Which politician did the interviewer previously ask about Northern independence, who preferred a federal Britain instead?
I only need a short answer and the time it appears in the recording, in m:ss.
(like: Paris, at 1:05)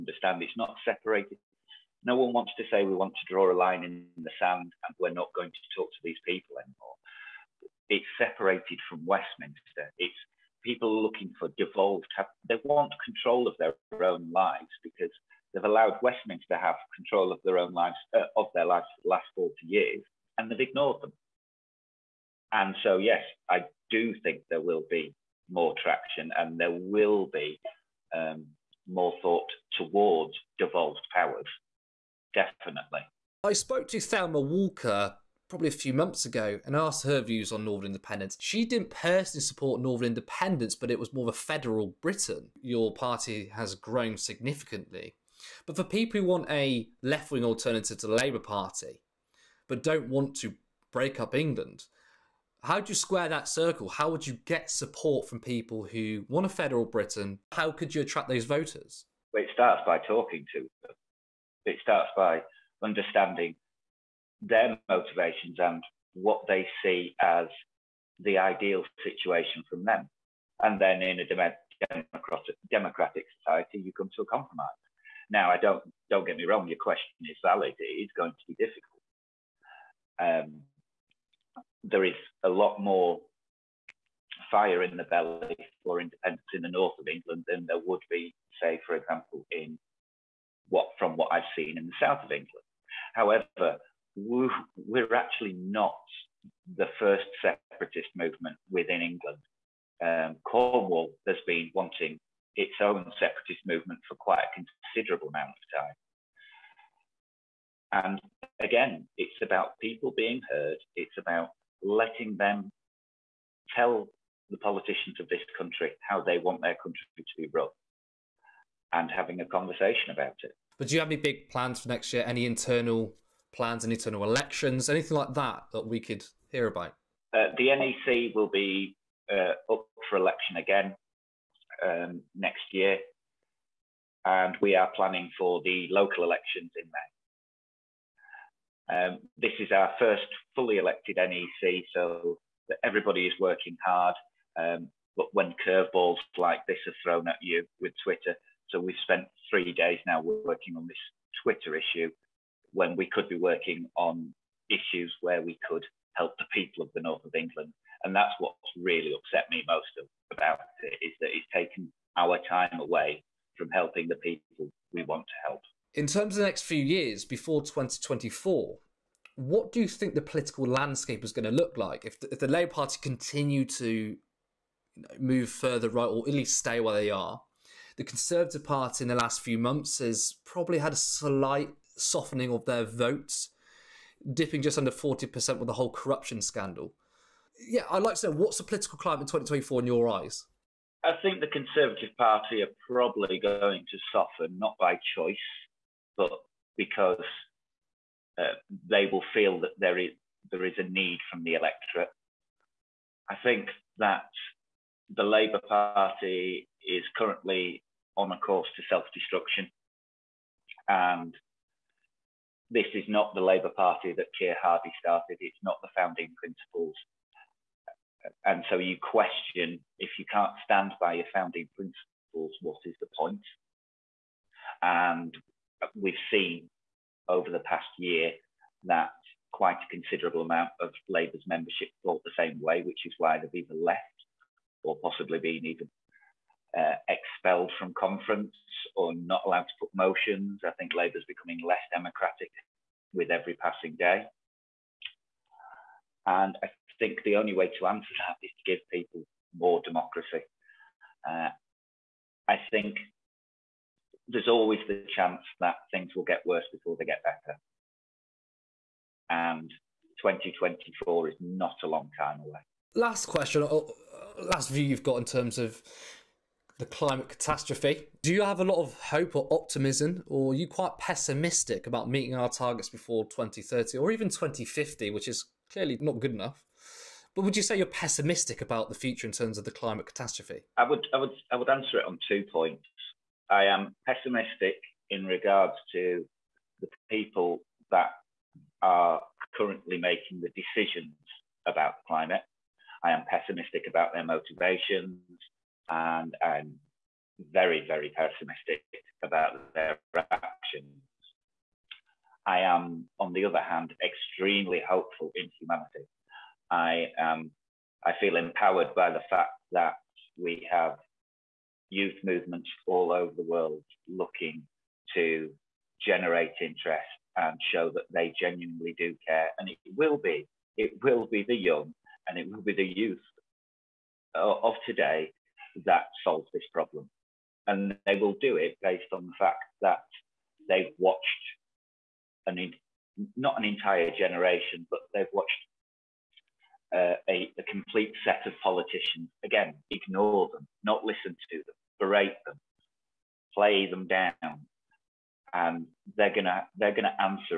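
Thelma Walker, at 0:33.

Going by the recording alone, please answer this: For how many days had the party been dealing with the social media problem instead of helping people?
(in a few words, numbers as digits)
3.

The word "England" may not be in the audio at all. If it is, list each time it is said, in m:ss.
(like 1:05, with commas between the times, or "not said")
0:51, 1:27, 1:32, 1:39, 2:37.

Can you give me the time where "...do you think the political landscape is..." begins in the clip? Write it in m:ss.
2:49.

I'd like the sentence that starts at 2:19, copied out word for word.
Um, this is our first fully elected NEC, so everybody is working hard.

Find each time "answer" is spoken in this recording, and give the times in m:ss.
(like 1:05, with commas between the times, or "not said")
4:07, 4:41.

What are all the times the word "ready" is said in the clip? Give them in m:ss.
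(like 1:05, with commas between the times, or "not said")
not said.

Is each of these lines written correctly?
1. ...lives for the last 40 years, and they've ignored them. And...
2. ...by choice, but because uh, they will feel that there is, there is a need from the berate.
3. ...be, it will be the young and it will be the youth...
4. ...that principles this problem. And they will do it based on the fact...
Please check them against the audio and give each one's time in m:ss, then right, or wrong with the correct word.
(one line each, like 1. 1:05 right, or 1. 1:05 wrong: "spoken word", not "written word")
1. 0:18 right
2. 3:14 wrong: "electorate", not "berate"
3. 5:20 right
4. 5:25 wrong: "solves", not "principles".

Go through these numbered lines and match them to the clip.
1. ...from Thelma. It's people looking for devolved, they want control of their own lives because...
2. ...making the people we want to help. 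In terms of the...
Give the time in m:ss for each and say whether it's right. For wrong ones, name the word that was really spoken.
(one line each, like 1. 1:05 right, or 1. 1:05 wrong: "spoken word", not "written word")
1. 0:08 wrong: "Westminster", not "Thelma"
2. 2:43 wrong: "helping", not "making".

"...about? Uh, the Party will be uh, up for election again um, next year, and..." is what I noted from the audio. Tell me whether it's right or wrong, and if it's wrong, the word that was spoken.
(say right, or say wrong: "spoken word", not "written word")
wrong: "NEC", not "Party".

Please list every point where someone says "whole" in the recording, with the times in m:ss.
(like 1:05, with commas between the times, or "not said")
3:05.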